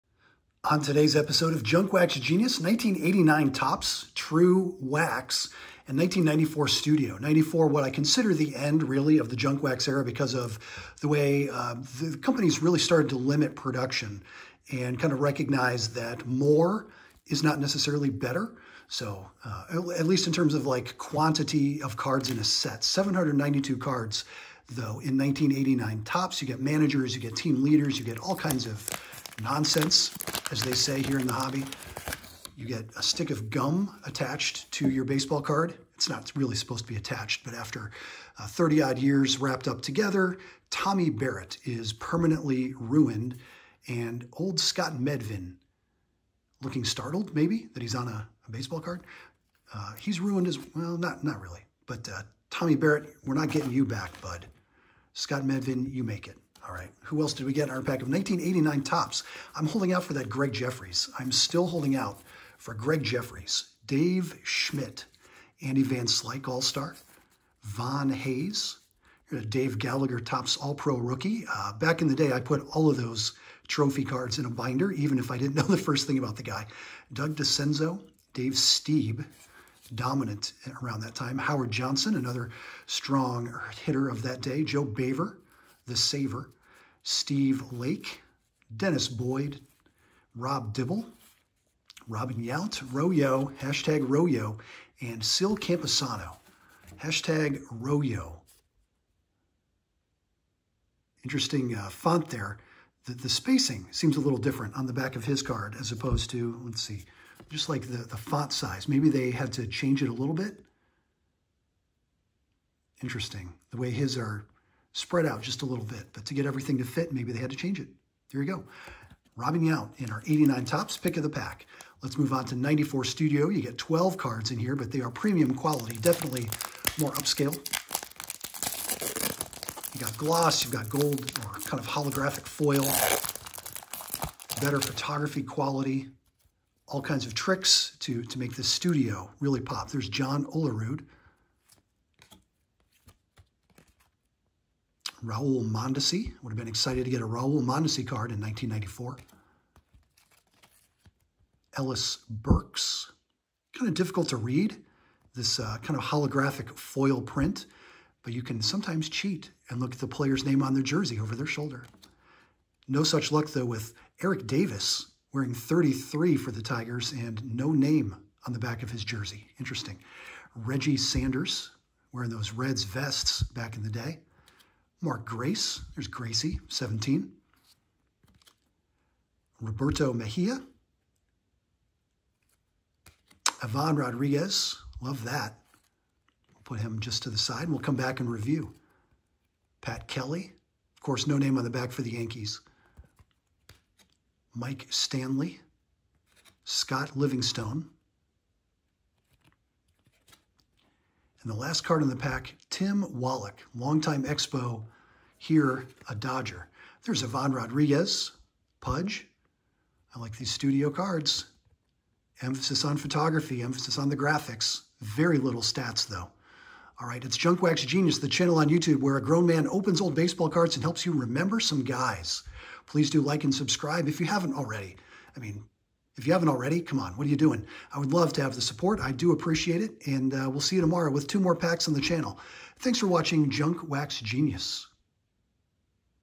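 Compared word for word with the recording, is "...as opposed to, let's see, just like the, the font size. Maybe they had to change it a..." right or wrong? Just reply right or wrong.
right.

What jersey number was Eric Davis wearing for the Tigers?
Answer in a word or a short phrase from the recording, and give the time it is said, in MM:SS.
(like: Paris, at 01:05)
33, at 02:45.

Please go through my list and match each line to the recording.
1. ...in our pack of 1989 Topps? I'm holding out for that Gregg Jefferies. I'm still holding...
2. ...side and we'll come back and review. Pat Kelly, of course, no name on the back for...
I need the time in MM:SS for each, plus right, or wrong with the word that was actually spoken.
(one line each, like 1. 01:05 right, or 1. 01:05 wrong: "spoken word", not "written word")
1. 00:57 right
2. 03:07 right.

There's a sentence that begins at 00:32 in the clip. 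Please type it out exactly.
You get a stick of gum attached to your baseball card.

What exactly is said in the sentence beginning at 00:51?
But uh, Tommy Barrett, we're not getting you back, bud.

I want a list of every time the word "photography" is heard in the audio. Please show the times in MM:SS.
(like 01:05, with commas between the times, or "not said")
02:14, 03:32.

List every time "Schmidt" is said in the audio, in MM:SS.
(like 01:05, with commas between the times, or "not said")
01:04.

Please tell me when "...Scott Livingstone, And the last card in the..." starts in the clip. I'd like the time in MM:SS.
03:16.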